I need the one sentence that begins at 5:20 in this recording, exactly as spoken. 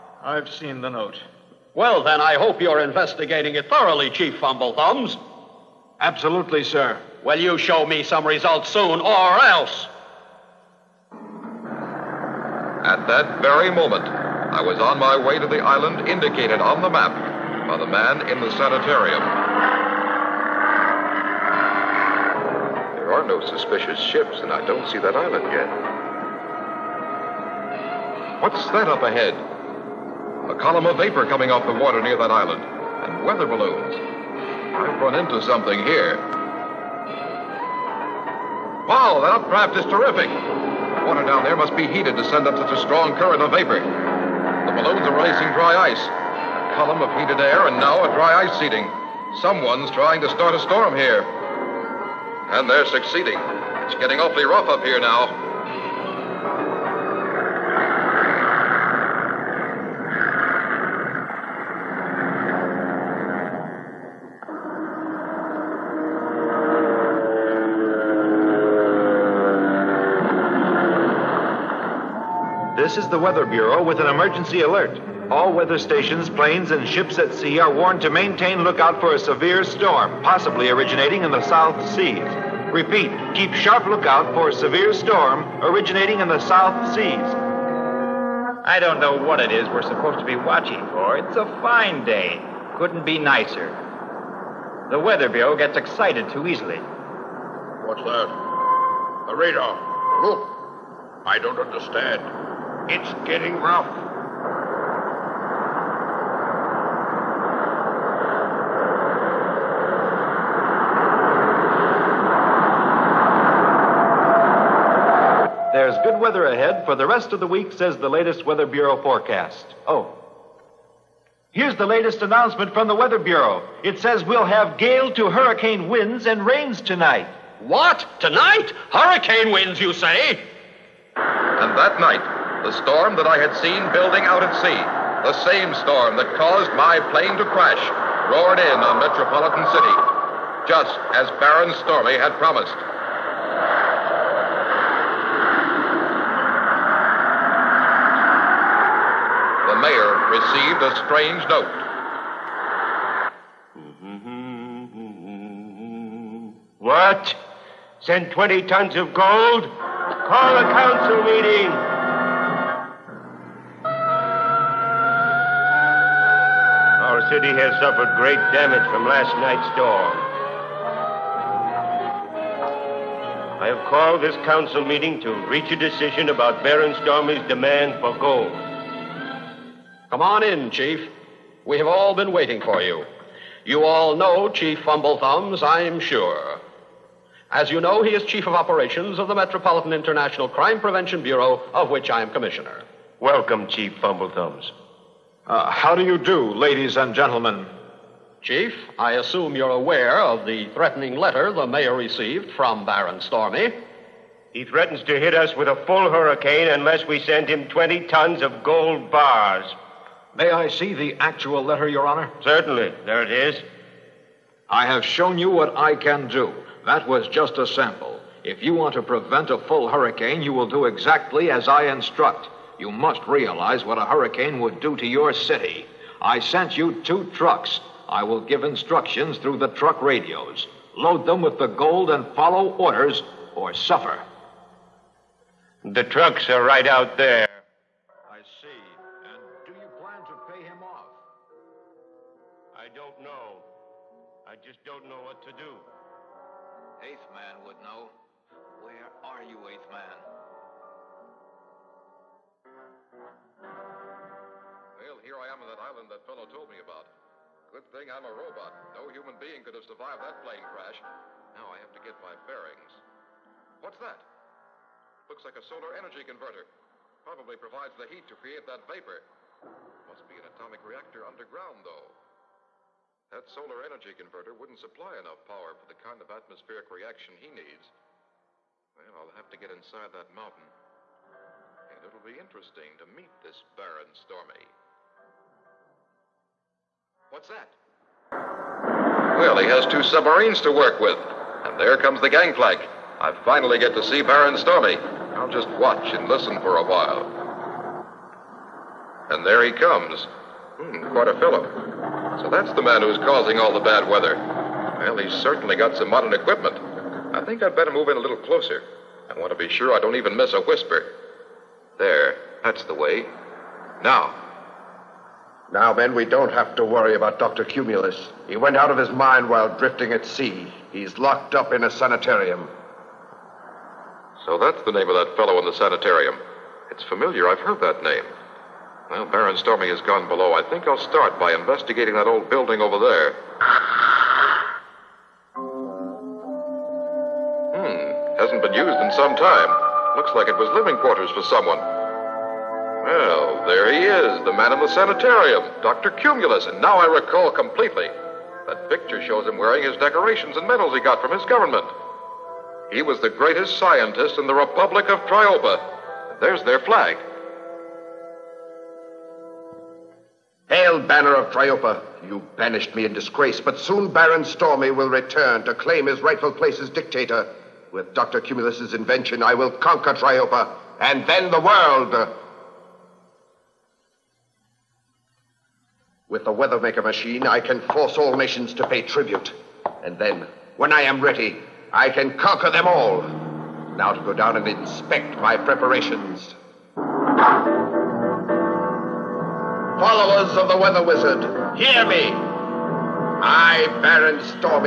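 He's locked up in a sanitarium.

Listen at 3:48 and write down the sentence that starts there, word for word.
I will give instructions through the truck radios.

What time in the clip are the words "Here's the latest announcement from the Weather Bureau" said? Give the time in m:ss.
2:01.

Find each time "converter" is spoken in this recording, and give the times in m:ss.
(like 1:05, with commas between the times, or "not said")
4:26, 4:34.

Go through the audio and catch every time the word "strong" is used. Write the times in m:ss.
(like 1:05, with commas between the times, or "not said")
0:42.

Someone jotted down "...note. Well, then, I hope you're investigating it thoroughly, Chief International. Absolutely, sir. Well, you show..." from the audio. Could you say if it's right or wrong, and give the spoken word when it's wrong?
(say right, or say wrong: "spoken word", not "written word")
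wrong: "Fumblethumbs", not "International".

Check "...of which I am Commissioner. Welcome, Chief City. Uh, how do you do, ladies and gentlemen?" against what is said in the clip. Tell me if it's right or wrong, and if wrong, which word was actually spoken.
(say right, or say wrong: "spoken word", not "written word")
wrong: "Fumblethumbs", not "City".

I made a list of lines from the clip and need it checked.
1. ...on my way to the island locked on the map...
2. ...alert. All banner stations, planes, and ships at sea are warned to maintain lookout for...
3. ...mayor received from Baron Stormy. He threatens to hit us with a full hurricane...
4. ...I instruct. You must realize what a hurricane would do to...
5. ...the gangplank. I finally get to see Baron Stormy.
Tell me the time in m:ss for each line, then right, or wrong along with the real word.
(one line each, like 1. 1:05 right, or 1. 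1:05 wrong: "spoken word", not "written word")
1. 0:14 wrong: "indicated", not "locked"
2. 1:14 wrong: "weather", not "banner"
3. 3:21 right
4. 3:41 right
5. 4:52 right.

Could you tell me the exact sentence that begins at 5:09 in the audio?
I want to be sure I don't even miss a whisper.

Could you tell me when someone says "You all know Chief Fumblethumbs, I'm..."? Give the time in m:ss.
3:03.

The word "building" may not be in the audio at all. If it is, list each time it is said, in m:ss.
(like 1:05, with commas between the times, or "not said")
2:13, 5:32.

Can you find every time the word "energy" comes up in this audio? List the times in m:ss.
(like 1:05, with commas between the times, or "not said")
4:25, 4:33.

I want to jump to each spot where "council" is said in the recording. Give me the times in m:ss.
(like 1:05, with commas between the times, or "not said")
2:40, 2:54.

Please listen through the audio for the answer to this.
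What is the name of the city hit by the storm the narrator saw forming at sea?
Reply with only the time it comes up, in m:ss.
2:19.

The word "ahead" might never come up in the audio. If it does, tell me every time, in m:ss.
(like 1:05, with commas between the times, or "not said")
0:29, 1:56.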